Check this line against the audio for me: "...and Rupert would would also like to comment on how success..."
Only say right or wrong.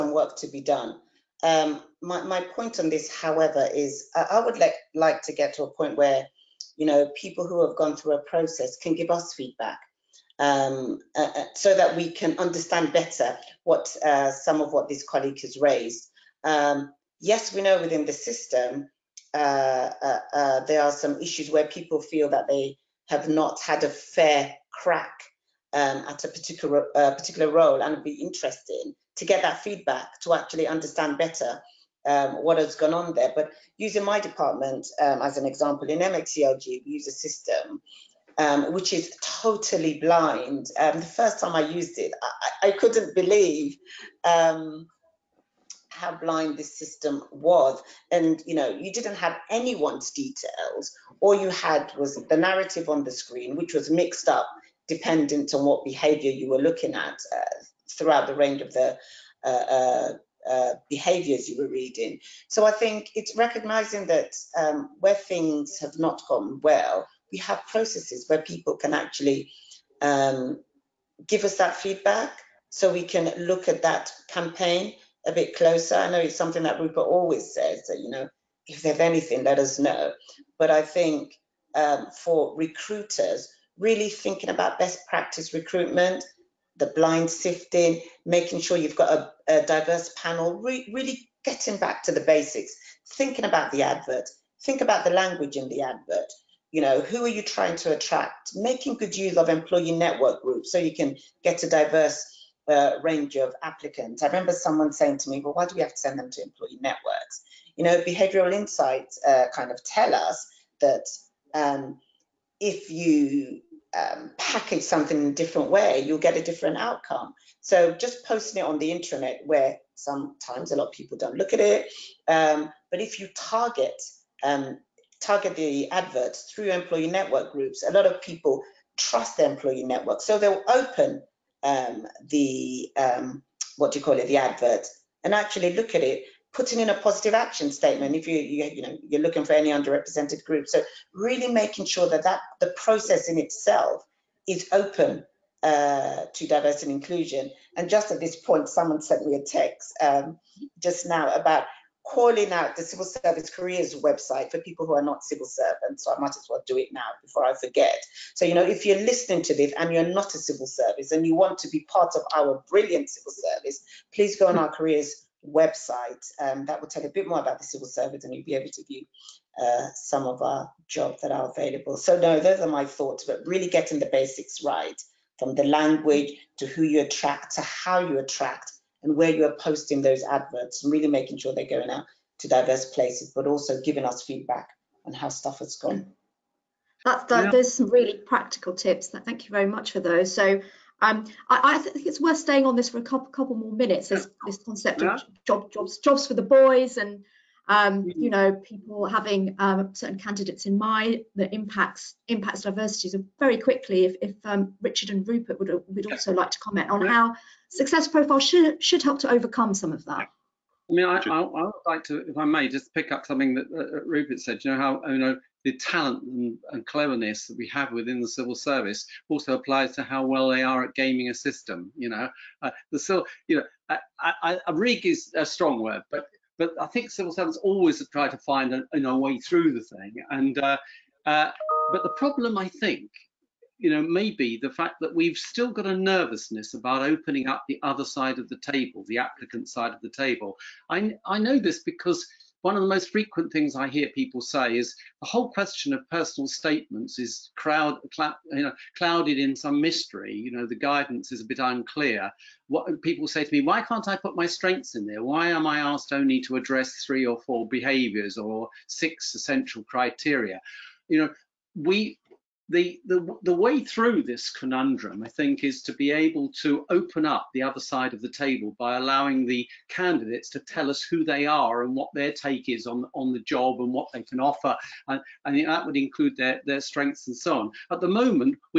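right.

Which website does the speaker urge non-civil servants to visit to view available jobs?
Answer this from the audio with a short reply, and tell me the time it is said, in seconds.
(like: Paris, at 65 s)
Civil service careers website, at 152 s.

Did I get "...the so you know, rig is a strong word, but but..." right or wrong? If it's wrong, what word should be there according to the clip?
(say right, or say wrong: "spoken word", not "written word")
right.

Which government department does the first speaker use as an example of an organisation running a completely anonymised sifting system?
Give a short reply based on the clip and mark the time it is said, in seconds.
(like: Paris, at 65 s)
MHCLG, at 35 s.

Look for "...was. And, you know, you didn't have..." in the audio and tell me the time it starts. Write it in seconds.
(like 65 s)
47 s.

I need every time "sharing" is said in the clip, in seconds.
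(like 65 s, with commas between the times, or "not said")
not said.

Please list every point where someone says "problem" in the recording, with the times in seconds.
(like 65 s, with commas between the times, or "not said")
232 s.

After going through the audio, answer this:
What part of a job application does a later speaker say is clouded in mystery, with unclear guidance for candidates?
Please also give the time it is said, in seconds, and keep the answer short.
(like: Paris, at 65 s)
Personal statements, at 246 s.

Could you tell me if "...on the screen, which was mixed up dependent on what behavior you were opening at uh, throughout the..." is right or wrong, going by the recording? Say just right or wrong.
wrong.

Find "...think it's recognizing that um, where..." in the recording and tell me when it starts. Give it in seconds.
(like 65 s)
62 s.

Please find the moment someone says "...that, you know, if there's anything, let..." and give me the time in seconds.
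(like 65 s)
77 s.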